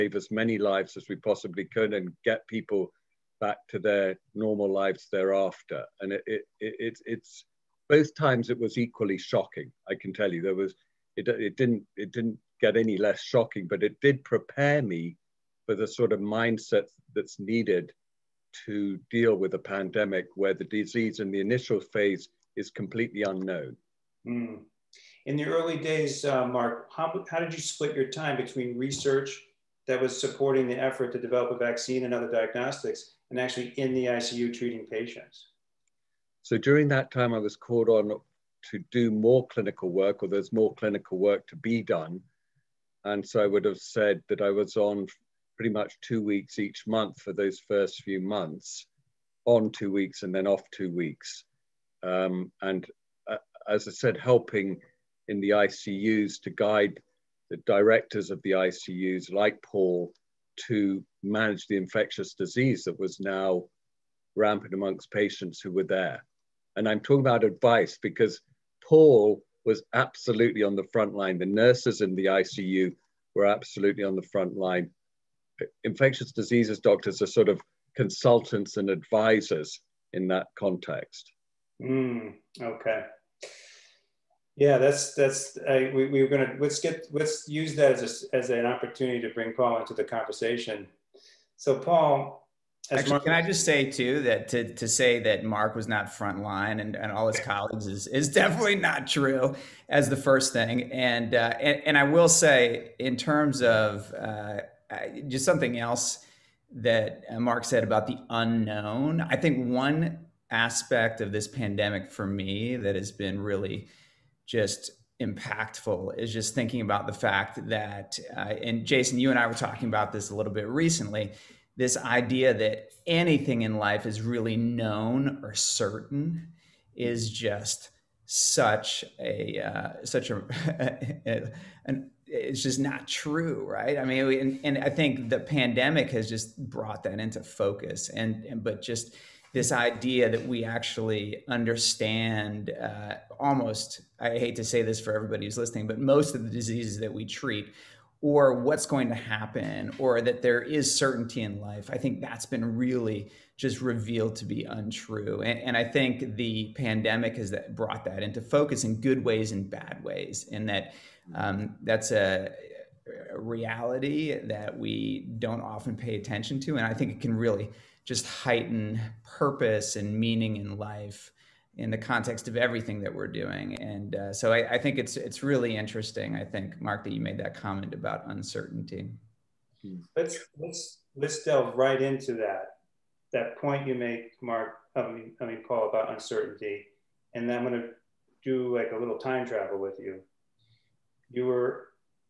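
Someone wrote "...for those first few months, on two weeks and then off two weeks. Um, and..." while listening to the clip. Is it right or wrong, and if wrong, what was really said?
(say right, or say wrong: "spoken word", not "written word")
right.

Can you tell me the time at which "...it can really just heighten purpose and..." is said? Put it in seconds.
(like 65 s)
167 s.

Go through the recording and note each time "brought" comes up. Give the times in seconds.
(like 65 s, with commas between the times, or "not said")
136 s, 157 s.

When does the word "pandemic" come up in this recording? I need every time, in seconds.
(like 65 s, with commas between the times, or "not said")
19 s, 111 s, 135 s, 156 s.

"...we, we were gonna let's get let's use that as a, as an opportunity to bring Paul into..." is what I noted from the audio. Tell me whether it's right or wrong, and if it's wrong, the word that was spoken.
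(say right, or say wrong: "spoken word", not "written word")
right.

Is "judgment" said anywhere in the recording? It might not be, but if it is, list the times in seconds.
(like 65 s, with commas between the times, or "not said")
not said.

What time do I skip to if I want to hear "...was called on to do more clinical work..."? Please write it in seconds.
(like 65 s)
37 s.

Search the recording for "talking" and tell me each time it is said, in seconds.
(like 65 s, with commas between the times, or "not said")
66 s, 119 s.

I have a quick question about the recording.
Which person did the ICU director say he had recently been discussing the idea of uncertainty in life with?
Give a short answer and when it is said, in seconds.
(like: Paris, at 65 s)
Jason, at 118 s.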